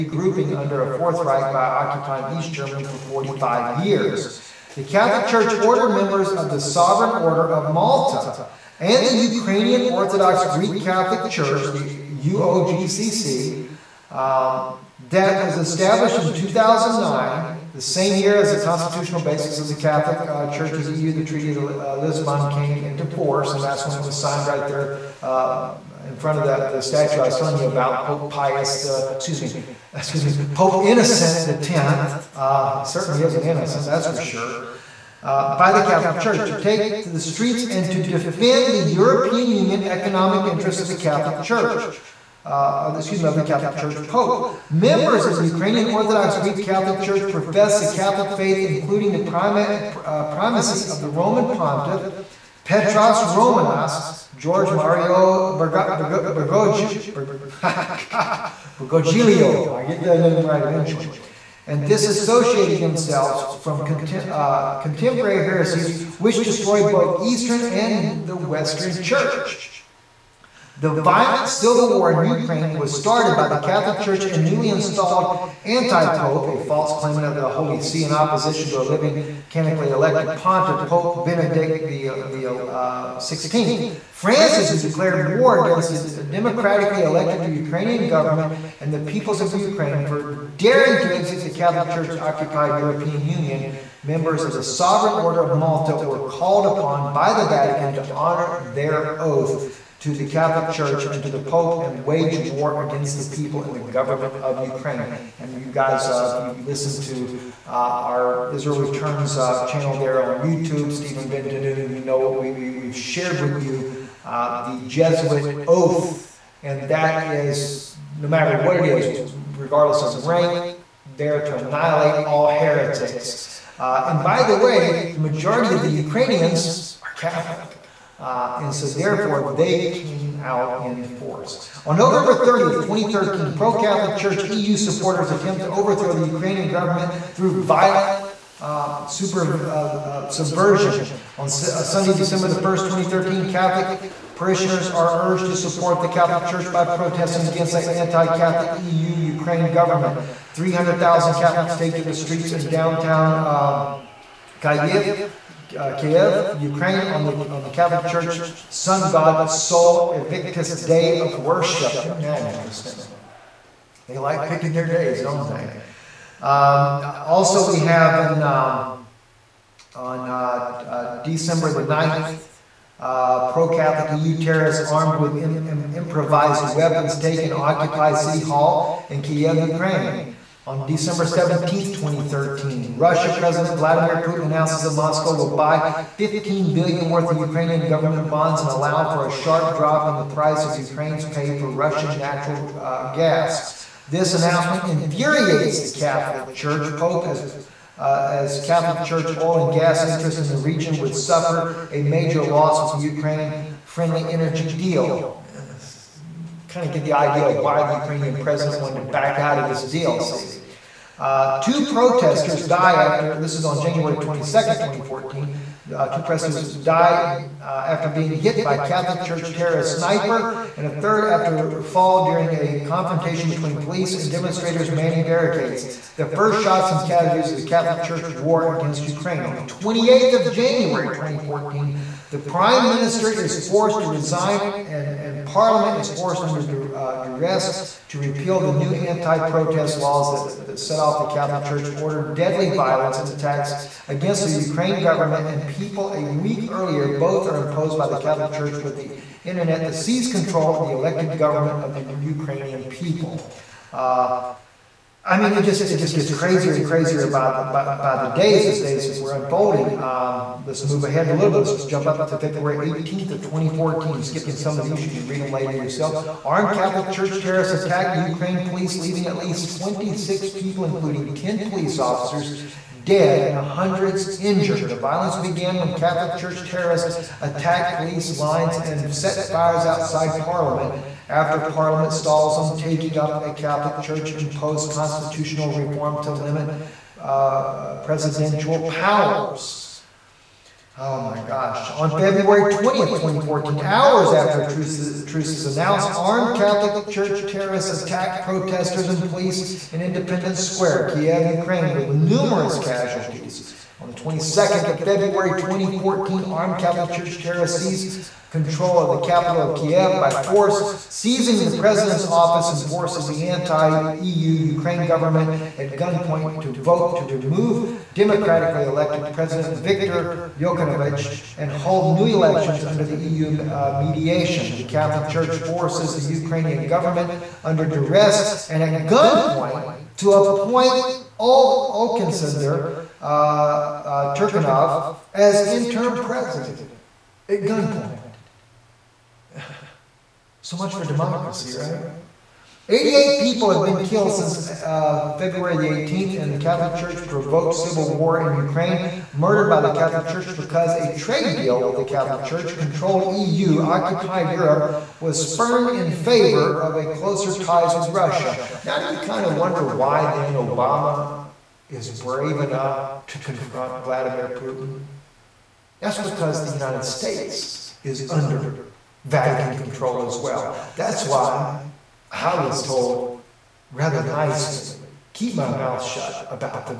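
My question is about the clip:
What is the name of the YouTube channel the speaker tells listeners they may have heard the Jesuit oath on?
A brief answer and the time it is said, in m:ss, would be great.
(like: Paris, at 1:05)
Israel Returns, at 1:48.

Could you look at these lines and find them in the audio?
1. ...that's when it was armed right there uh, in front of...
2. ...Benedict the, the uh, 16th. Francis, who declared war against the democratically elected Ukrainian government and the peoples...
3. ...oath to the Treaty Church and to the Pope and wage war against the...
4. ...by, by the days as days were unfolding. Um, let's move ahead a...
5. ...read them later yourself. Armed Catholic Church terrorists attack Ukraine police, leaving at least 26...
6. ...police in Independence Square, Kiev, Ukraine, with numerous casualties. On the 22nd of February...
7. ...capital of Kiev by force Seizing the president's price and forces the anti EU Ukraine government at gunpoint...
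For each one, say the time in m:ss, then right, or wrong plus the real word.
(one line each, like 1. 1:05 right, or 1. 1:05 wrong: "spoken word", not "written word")
1. 0:23 wrong: "signed", not "armed"
2. 1:21 right
3. 1:39 wrong: "Catholic", not "Treaty"
4. 4:17 right
5. 4:25 right
6. 4:59 right
7. 5:09 wrong: "office", not "price".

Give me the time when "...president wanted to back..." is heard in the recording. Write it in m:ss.
3:28.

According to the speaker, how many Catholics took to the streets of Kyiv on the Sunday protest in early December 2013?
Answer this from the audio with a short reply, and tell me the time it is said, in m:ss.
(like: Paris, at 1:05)
300,000, at 2:30.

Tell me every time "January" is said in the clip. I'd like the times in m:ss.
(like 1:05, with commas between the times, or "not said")
3:33, 3:50.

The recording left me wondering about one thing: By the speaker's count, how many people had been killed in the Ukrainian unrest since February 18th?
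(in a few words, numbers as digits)
88.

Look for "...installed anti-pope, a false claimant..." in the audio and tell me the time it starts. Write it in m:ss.
1:14.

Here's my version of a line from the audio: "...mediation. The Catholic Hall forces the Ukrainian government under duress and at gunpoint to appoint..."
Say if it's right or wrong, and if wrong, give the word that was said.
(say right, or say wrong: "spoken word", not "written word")
wrong: "Church", not "Hall".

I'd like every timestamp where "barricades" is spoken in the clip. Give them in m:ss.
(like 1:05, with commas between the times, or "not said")
3:45.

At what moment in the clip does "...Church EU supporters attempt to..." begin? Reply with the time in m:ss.
2:14.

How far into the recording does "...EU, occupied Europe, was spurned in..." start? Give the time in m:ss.
5:53.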